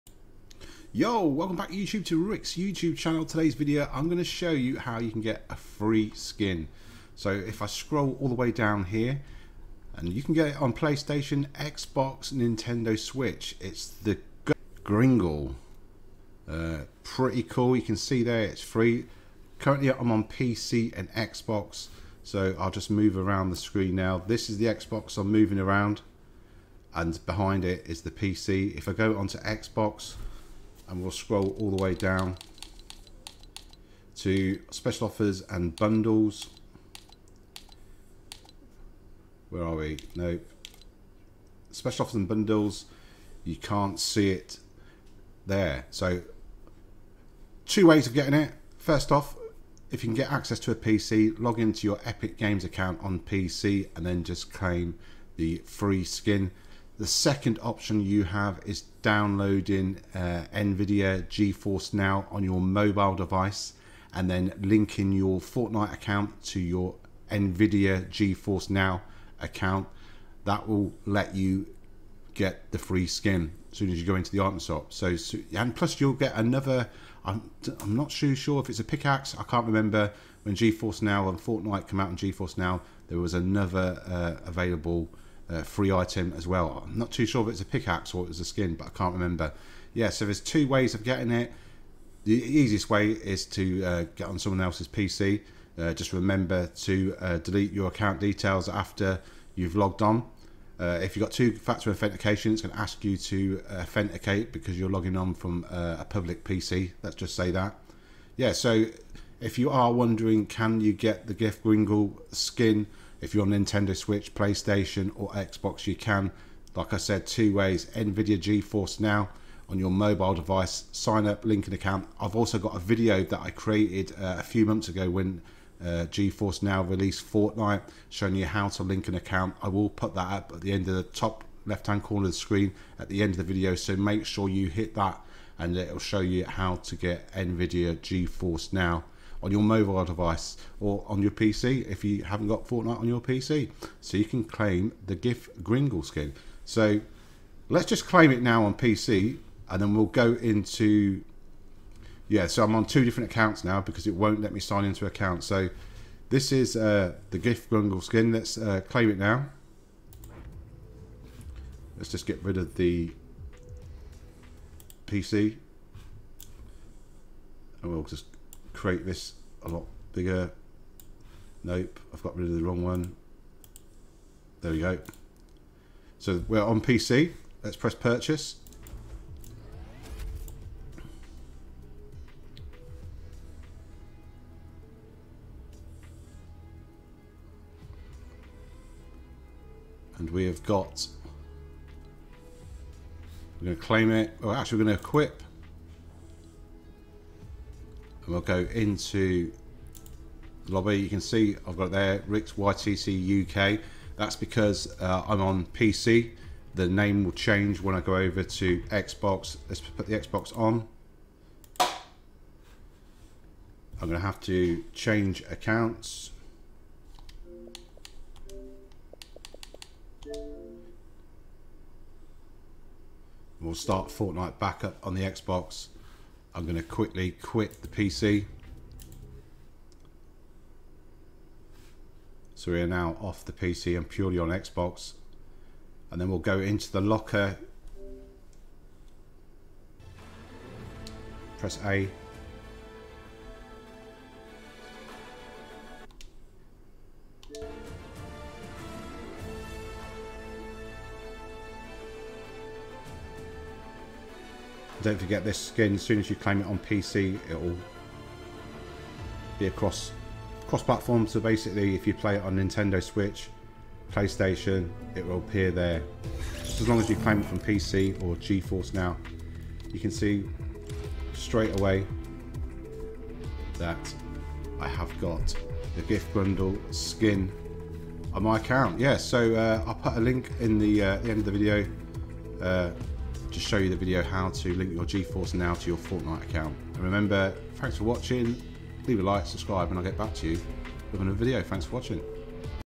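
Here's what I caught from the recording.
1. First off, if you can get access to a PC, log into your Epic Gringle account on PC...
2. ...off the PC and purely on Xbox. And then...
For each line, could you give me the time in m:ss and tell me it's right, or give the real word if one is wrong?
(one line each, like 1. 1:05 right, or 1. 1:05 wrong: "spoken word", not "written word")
1. 0:48 wrong: "Games", not "Gringle"
2. 3:53 right.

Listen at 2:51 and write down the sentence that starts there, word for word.
Nope, I've got rid of the wrong one.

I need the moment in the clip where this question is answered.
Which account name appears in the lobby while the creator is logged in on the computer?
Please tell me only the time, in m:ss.
3:22.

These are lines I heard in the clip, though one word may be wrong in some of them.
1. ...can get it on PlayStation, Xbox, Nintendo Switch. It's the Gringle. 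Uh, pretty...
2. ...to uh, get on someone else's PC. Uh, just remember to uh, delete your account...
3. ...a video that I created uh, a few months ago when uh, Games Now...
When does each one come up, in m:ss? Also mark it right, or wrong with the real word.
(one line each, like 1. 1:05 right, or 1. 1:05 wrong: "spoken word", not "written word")
1. 0:10 right
2. 1:33 right
3. 2:02 wrong: "GeForce", not "Games".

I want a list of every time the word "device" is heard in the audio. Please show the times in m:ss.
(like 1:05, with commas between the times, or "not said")
1:03, 2:00, 2:20.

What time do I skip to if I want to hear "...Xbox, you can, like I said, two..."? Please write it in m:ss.
1:55.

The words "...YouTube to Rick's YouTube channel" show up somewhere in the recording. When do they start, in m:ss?
0:01.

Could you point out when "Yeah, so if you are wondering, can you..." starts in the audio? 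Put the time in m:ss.
1:48.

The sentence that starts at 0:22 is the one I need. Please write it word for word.
So I'll just move around the screen now.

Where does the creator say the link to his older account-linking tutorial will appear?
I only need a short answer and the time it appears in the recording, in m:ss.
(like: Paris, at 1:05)
top left, at 2:11.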